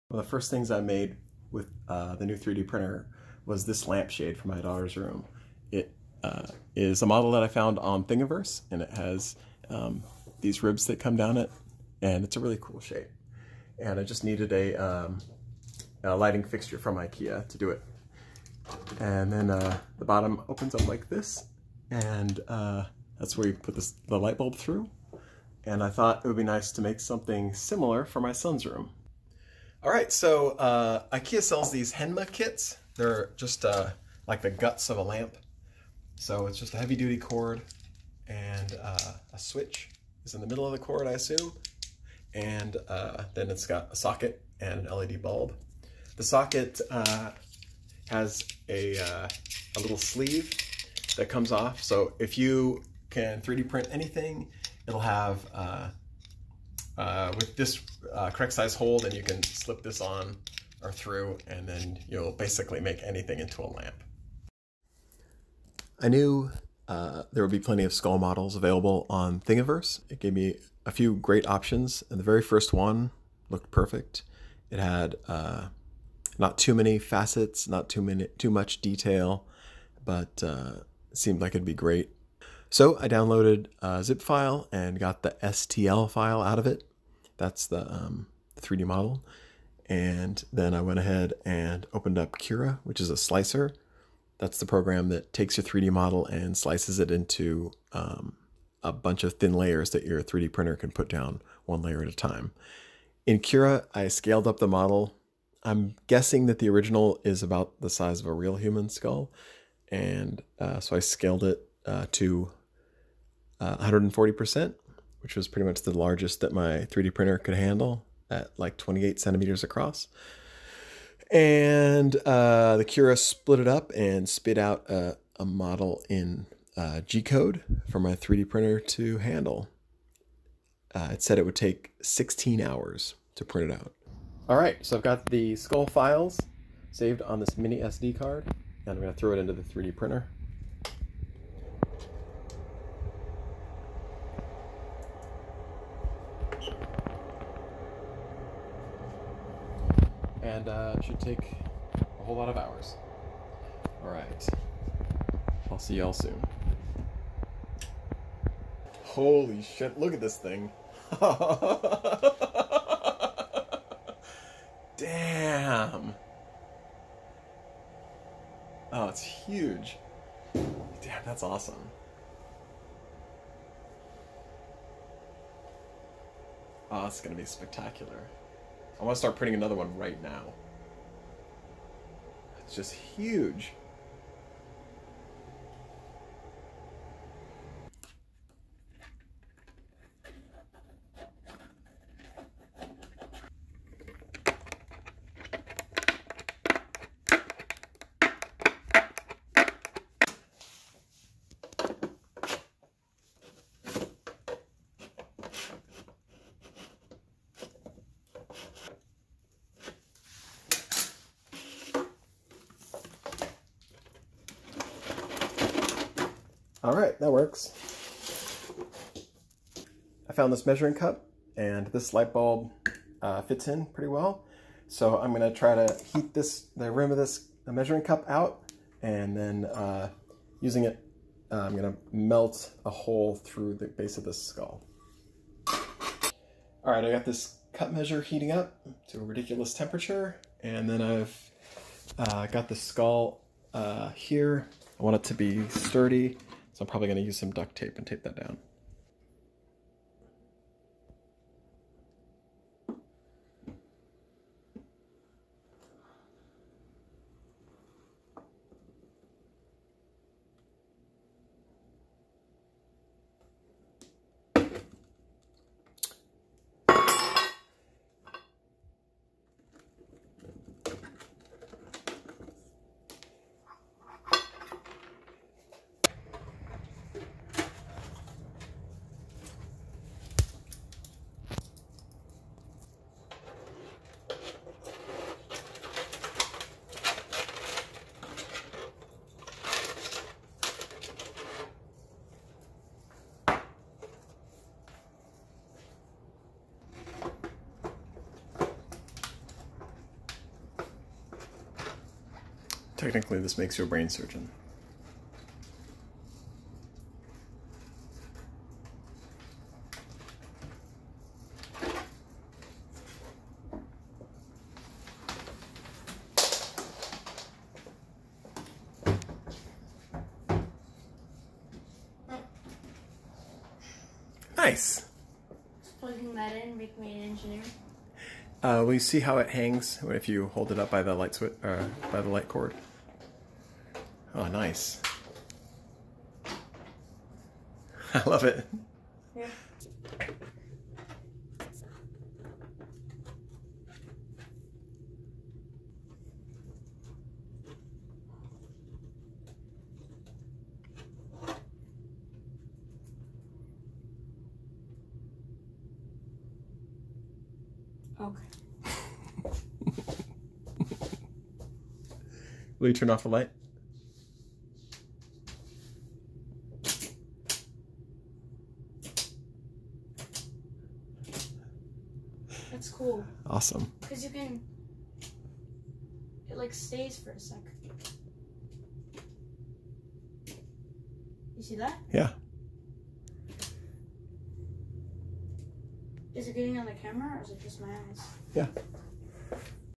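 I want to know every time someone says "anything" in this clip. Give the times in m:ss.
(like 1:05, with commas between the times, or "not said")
0:53, 1:03.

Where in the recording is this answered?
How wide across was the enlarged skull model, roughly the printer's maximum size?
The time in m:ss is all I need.
1:58.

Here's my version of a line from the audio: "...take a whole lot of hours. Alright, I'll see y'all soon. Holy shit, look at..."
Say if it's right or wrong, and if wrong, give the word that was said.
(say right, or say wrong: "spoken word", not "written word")
right.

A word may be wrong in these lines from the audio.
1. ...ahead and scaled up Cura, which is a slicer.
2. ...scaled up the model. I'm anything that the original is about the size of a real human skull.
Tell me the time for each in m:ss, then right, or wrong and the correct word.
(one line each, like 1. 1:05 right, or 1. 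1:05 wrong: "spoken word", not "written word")
1. 1:30 wrong: "opened", not "scaled"
2. 1:44 wrong: "guessing", not "anything".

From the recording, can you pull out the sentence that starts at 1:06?
I knew uh, there would be plenty of skull models available on Thingiverse.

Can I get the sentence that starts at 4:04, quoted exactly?
I want it to be sturdy so I'm probably going to use some duct tape and tape that down.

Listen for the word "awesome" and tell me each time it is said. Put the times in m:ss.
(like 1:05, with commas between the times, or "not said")
2:51, 6:13.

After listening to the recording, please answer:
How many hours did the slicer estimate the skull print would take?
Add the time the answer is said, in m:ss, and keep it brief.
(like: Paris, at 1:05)
16 hours, at 2:12.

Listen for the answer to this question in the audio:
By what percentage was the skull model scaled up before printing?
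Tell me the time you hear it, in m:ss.
1:53.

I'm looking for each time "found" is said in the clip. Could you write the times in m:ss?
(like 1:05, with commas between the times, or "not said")
0:07, 3:40.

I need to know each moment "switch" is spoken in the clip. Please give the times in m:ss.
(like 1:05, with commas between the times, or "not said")
0:39, 5:31.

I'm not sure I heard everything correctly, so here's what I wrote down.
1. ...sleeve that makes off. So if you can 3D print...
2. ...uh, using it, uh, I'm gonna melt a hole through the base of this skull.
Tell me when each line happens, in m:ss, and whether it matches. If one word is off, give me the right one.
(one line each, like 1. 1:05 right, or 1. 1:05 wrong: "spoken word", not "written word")
1. 0:49 wrong: "comes", not "makes"
2. 3:49 right.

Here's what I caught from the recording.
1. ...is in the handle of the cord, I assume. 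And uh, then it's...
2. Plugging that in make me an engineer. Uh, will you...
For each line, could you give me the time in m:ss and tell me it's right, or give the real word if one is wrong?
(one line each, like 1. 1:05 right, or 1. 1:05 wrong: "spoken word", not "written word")
1. 0:40 wrong: "middle", not "handle"
2. 5:25 right.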